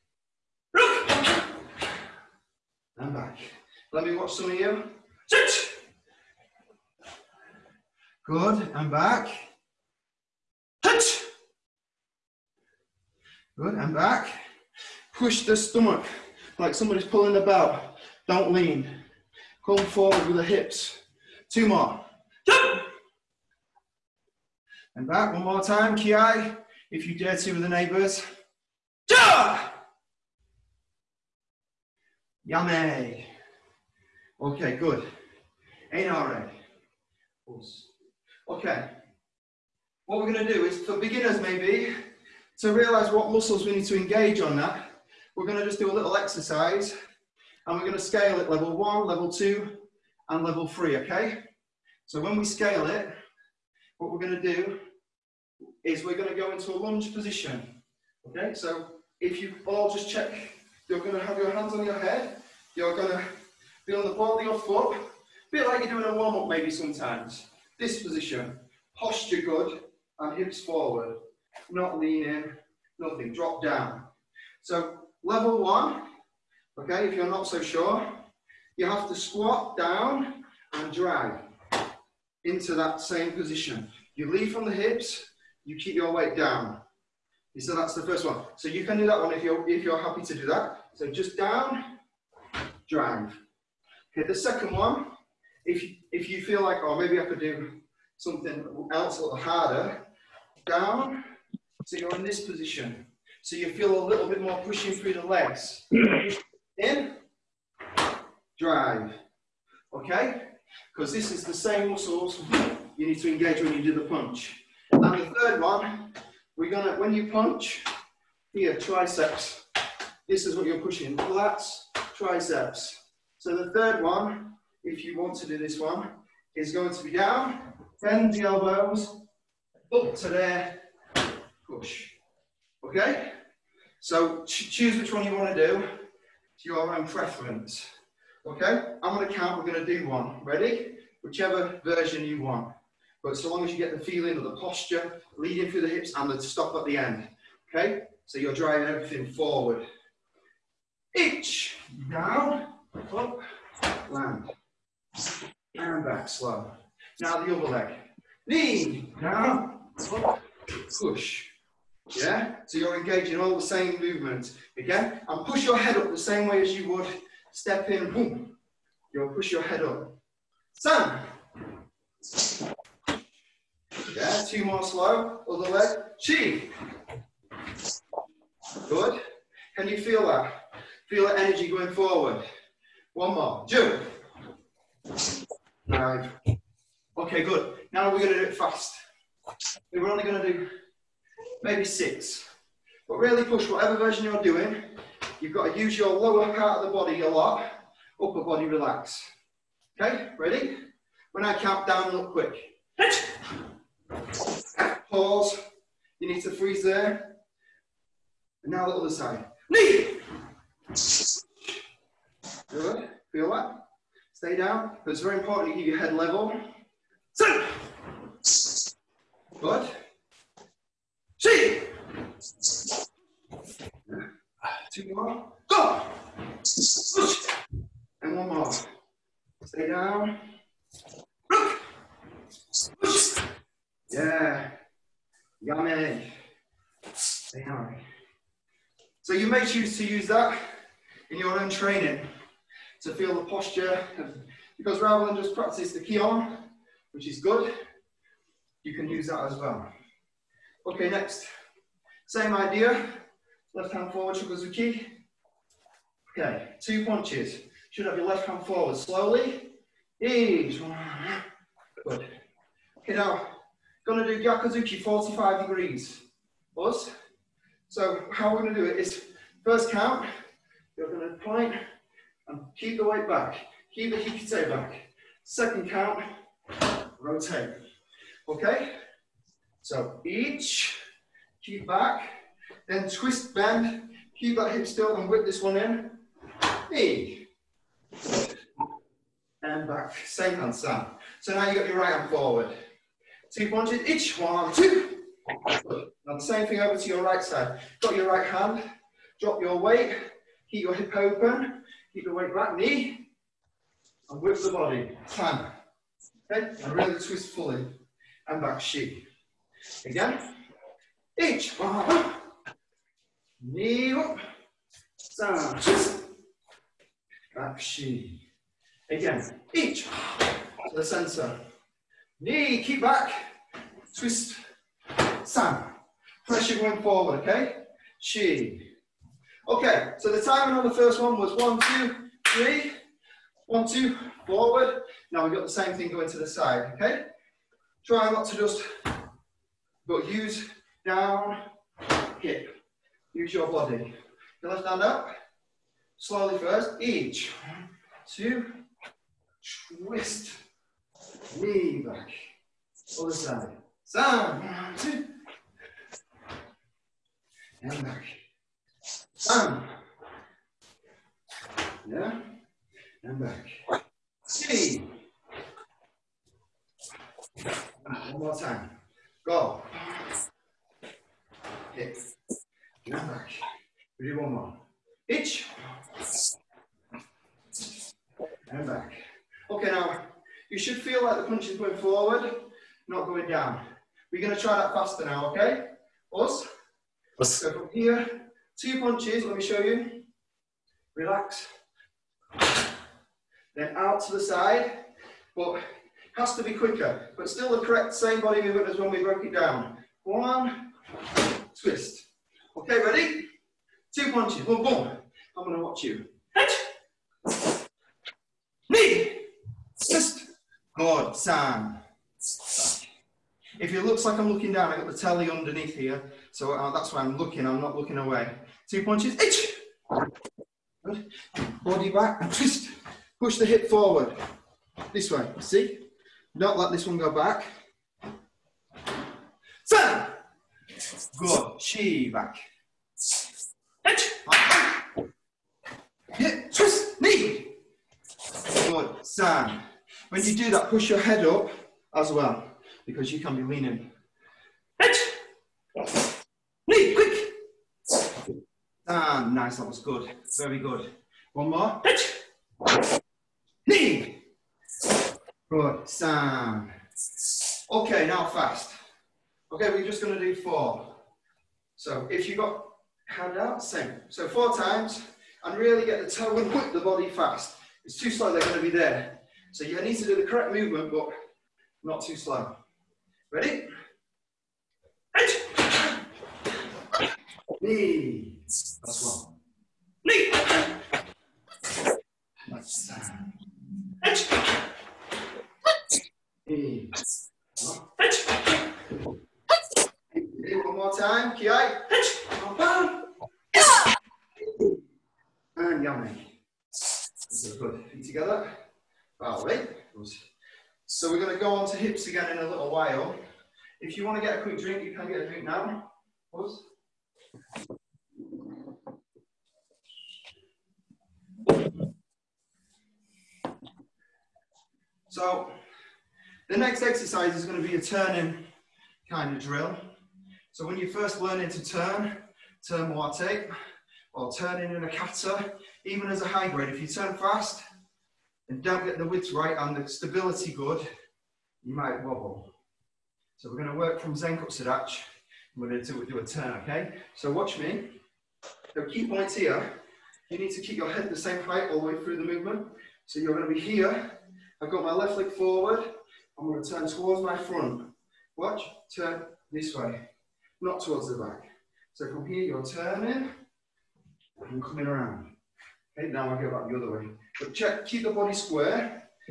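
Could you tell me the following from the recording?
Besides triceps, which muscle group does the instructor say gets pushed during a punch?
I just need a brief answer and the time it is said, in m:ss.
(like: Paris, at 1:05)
lats, at 2:01.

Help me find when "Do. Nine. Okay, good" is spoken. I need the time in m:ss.
3:03.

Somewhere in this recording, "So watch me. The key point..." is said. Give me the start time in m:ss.
8:57.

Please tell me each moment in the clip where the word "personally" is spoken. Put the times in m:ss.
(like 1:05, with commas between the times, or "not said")
not said.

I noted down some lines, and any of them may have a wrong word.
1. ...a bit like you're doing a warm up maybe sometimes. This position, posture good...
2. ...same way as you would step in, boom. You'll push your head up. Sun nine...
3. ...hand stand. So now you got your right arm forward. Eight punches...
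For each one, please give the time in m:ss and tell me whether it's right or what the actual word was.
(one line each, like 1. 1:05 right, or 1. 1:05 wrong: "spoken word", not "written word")
1. 1:04 right
2. 2:46 wrong: "two", not "nine"
3. 4:50 wrong: "Two", not "Eight".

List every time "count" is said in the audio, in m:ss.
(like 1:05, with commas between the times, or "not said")
2:19, 3:21, 4:29, 4:35.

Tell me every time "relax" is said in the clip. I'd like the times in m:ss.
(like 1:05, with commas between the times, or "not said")
3:18, 6:31.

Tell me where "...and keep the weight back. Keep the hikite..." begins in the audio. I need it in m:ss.
4:32.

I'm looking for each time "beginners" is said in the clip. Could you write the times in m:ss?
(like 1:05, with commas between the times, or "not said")
0:40.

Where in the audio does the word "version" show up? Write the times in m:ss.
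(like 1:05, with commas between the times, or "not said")
2:21, 3:13.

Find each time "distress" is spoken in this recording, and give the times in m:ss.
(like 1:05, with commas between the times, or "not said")
not said.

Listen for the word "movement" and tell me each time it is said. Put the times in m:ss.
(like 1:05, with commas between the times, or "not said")
2:43, 6:38, 7:50, 9:02.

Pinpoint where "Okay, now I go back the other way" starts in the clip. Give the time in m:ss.
9:16.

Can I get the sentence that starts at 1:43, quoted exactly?
So you feel a little bit more pushing through the legs.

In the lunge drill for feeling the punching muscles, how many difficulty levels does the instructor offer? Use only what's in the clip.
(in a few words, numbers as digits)
3.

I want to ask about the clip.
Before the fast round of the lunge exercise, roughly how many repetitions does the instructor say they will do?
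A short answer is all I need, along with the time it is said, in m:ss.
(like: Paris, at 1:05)
6, at 3:11.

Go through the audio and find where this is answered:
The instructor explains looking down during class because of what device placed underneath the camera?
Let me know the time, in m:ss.
6:55.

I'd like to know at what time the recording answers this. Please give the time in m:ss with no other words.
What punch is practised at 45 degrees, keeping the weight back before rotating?
4:24.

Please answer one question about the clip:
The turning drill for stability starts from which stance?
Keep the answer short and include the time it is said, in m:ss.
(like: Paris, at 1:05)
Zenkutsu Dachi, at 8:54.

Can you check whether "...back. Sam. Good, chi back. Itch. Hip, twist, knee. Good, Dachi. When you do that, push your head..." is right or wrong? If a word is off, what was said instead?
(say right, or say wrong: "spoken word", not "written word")
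wrong: "Sam", not "Dachi".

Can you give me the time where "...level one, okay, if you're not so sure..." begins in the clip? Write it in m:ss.
1:15.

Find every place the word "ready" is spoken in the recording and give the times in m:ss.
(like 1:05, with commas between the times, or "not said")
2:20, 3:20, 6:42, 7:53.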